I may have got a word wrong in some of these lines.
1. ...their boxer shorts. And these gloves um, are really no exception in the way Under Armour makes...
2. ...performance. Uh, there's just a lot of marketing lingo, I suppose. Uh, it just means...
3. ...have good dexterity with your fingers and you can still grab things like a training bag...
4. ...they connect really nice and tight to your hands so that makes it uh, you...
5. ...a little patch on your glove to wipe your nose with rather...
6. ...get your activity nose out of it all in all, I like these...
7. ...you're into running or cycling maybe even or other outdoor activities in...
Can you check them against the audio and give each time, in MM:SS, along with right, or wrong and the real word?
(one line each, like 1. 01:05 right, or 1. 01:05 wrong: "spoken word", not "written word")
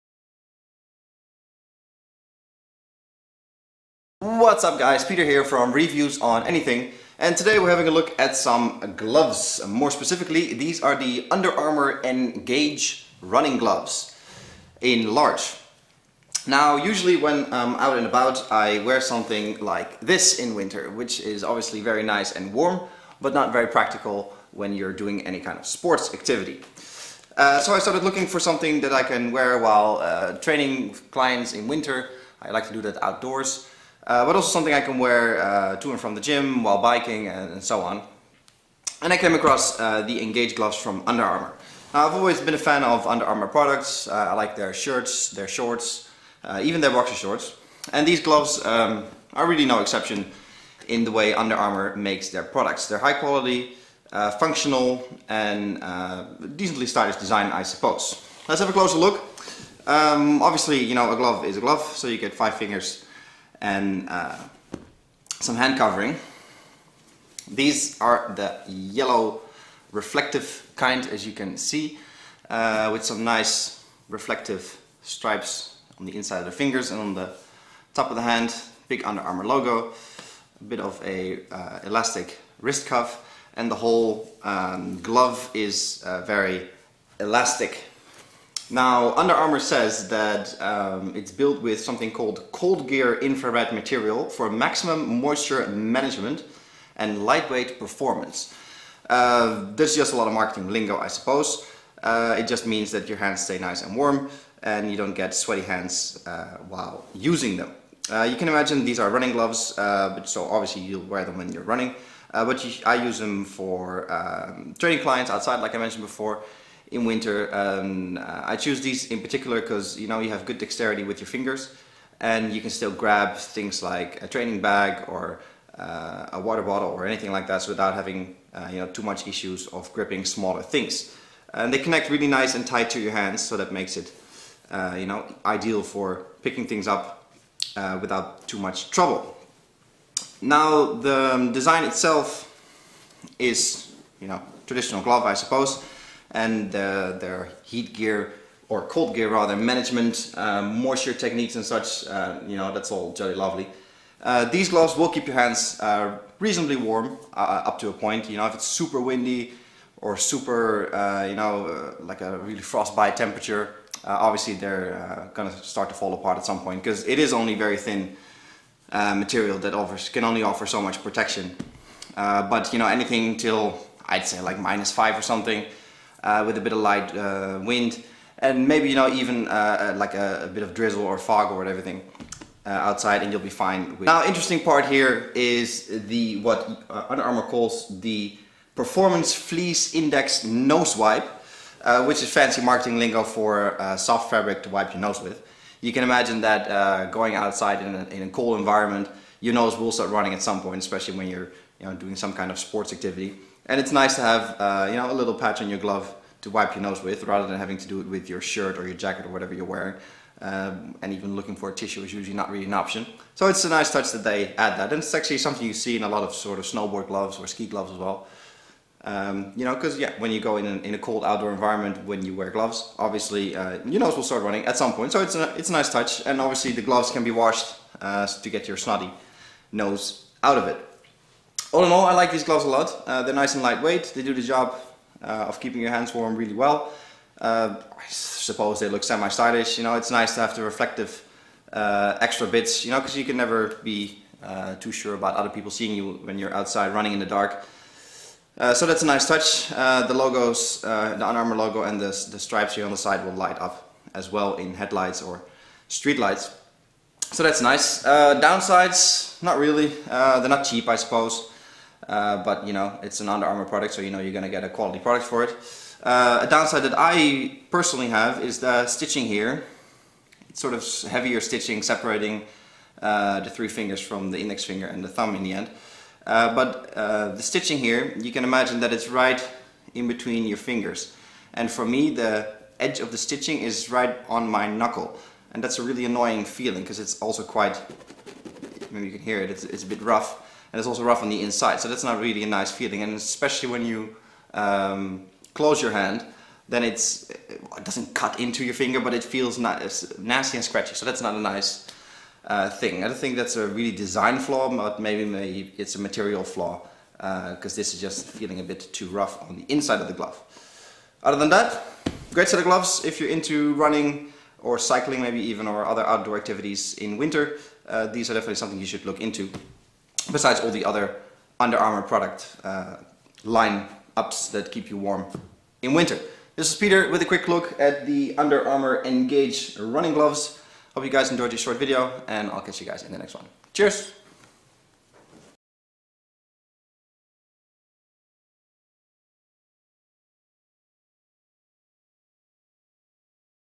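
1. 00:46 right
2. 01:37 right
3. 02:00 right
4. 02:11 right
5. 03:25 right
6. 03:48 wrong: "snotty", not "activity"
7. 05:13 right.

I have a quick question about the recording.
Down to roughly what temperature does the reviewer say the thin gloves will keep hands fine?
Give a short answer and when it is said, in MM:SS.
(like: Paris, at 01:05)
-5, at 02:54.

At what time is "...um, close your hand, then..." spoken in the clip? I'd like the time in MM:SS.
04:54.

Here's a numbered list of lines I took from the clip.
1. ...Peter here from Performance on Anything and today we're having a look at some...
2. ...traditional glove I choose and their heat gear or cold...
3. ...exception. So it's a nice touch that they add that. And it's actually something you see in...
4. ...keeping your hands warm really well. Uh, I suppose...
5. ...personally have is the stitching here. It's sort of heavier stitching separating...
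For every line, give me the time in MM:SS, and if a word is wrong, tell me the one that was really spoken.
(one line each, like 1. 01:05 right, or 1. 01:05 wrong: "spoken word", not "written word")
1. 00:05 wrong: "Reviews", not "Performance"
2. 02:24 wrong: "suppose", not "choose"
3. 03:32 wrong: "option", not "exception"
4. 03:55 right
5. 04:27 right.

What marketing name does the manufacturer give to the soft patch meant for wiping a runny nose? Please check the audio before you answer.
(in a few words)
Performance Fleece Index Nose Wipe.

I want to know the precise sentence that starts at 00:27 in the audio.
Uh, so I started looking for something that I can wear while uh, training clients in winter.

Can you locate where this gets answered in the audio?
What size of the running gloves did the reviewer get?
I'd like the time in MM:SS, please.
00:15.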